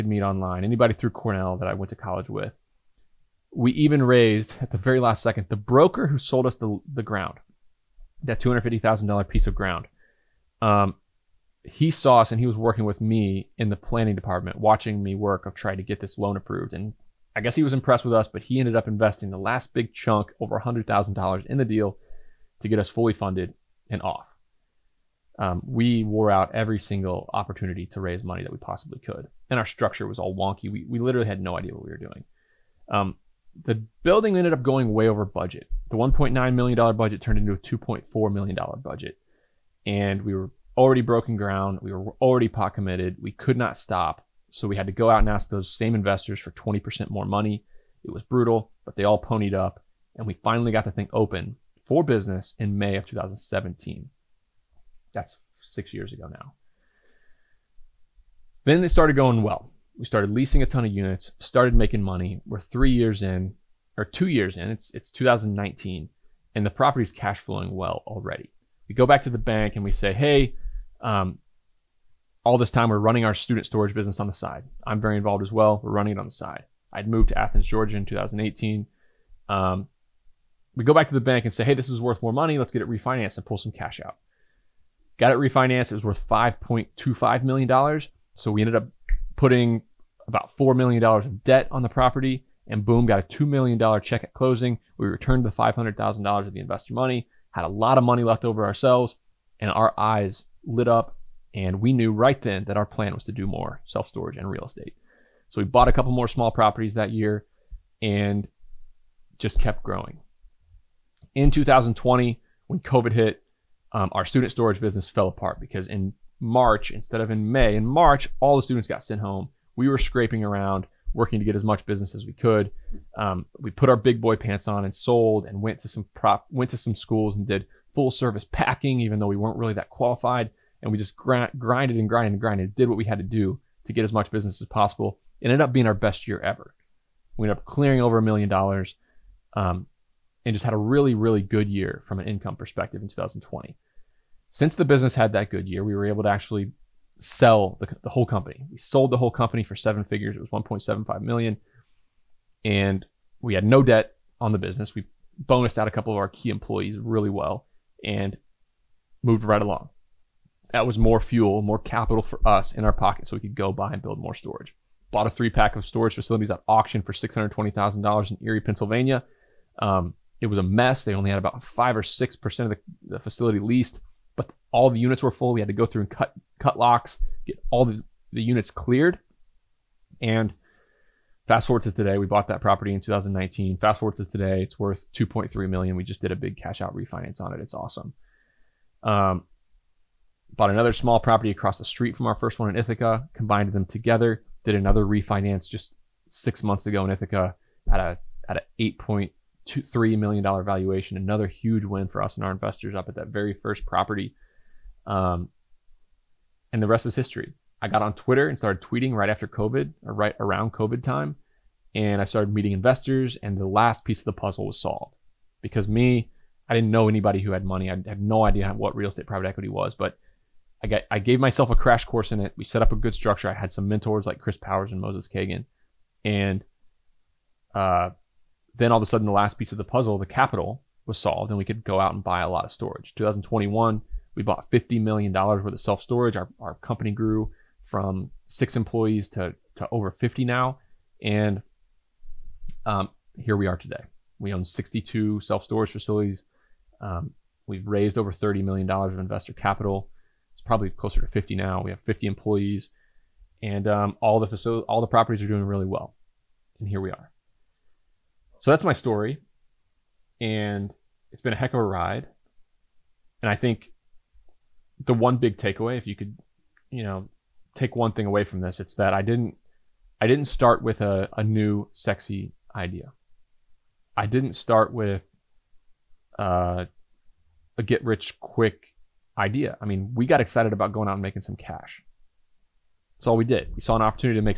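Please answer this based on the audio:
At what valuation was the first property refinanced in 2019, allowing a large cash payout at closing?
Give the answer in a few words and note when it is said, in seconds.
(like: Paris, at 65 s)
$5.25 million, at 86 s.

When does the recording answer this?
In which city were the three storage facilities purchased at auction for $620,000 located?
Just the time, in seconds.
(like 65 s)
168 s.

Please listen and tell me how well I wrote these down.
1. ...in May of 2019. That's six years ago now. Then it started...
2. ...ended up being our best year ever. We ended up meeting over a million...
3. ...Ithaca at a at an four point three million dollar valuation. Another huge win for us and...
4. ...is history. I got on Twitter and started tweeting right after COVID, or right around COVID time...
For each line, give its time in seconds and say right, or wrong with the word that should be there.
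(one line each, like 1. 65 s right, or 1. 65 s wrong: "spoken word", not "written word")
1. 52 s wrong: "2017", not "2019"
2. 135 s wrong: "clearing", not "meeting"
3. 197 s wrong: "eight", not "four"
4. 207 s right.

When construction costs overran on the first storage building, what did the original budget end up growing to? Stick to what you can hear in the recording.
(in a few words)
$2.4 million.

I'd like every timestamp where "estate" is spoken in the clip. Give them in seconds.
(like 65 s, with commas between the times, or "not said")
104 s, 219 s.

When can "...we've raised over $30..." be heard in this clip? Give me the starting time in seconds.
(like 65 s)
247 s.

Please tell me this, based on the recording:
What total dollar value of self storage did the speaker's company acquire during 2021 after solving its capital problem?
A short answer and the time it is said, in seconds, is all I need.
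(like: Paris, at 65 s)
$50 million, at 234 s.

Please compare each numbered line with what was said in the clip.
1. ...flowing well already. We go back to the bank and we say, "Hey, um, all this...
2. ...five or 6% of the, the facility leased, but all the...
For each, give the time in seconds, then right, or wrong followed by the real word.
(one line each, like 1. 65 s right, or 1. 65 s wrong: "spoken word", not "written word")
1. 67 s right
2. 171 s right.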